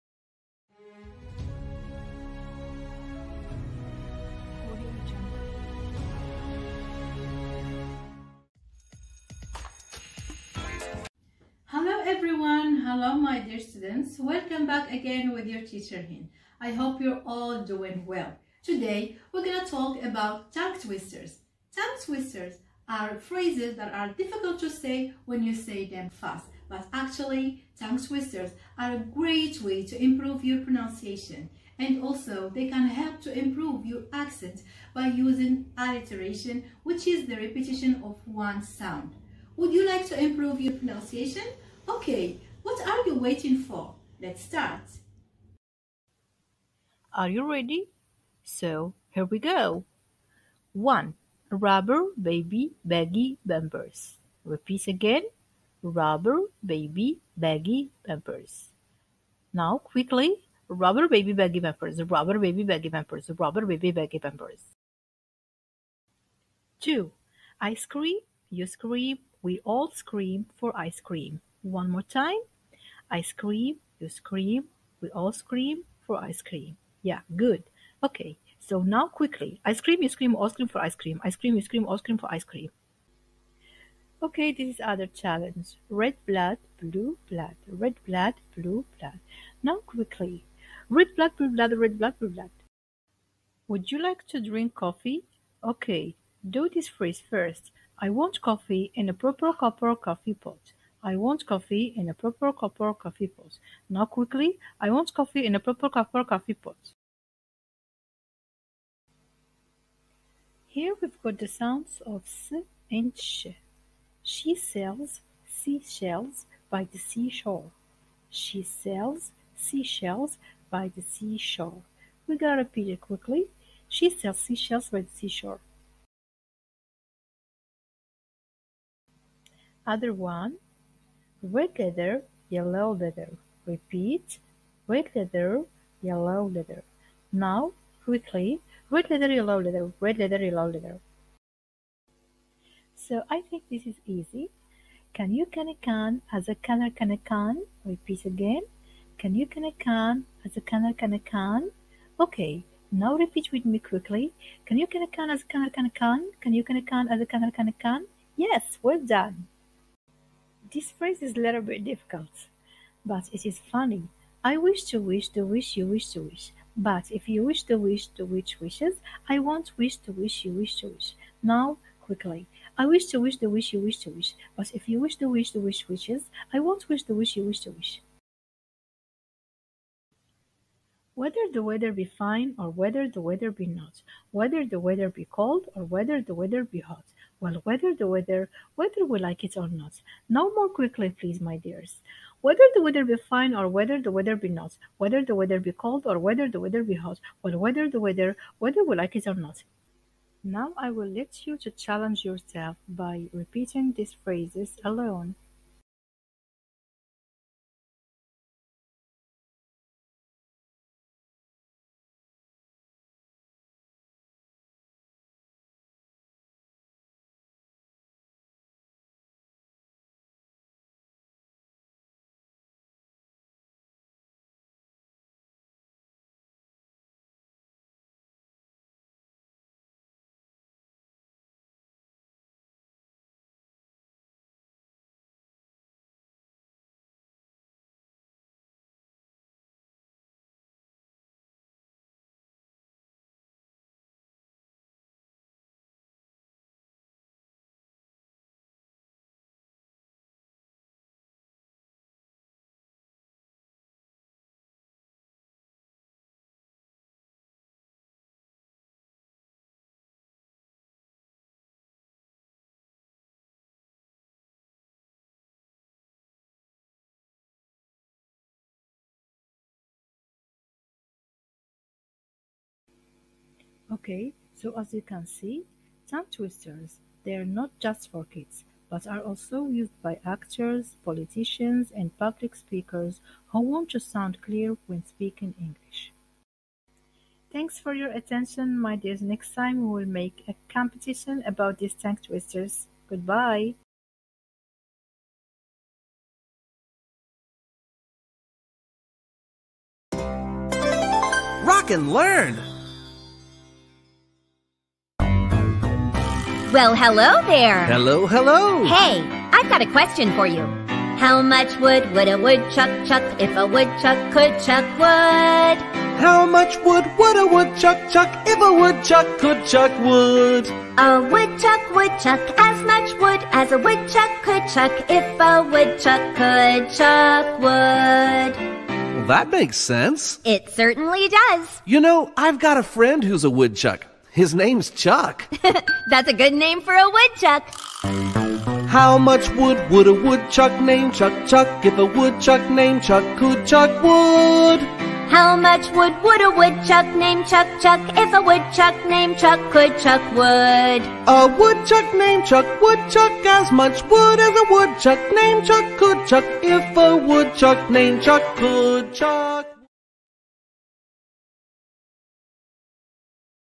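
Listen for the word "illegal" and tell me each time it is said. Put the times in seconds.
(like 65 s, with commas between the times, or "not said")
not said.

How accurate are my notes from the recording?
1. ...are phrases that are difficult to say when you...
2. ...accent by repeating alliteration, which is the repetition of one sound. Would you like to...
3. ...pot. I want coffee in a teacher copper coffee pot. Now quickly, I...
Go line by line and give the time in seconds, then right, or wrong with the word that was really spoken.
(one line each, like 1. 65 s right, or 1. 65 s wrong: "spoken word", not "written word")
1. 22 s right
2. 34 s wrong: "using", not "repeating"
3. 100 s wrong: "proper", not "teacher".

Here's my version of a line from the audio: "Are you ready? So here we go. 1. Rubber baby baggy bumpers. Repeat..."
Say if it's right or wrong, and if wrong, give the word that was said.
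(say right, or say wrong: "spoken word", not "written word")
right.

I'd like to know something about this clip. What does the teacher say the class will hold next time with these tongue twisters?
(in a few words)
a competition.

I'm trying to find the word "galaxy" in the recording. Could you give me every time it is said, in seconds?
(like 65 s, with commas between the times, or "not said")
not said.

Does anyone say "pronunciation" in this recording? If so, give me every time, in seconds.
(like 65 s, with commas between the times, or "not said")
30 s, 40 s.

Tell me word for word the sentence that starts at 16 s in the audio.
I hope you're all doing well.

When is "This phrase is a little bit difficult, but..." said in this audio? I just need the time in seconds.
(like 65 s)
160 s.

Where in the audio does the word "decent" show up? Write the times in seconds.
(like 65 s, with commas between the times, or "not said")
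not said.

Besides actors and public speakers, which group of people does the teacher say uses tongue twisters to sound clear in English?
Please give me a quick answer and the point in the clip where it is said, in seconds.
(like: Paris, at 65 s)
politicians, at 281 s.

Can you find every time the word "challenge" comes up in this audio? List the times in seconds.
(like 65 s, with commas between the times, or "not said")
85 s, 201 s.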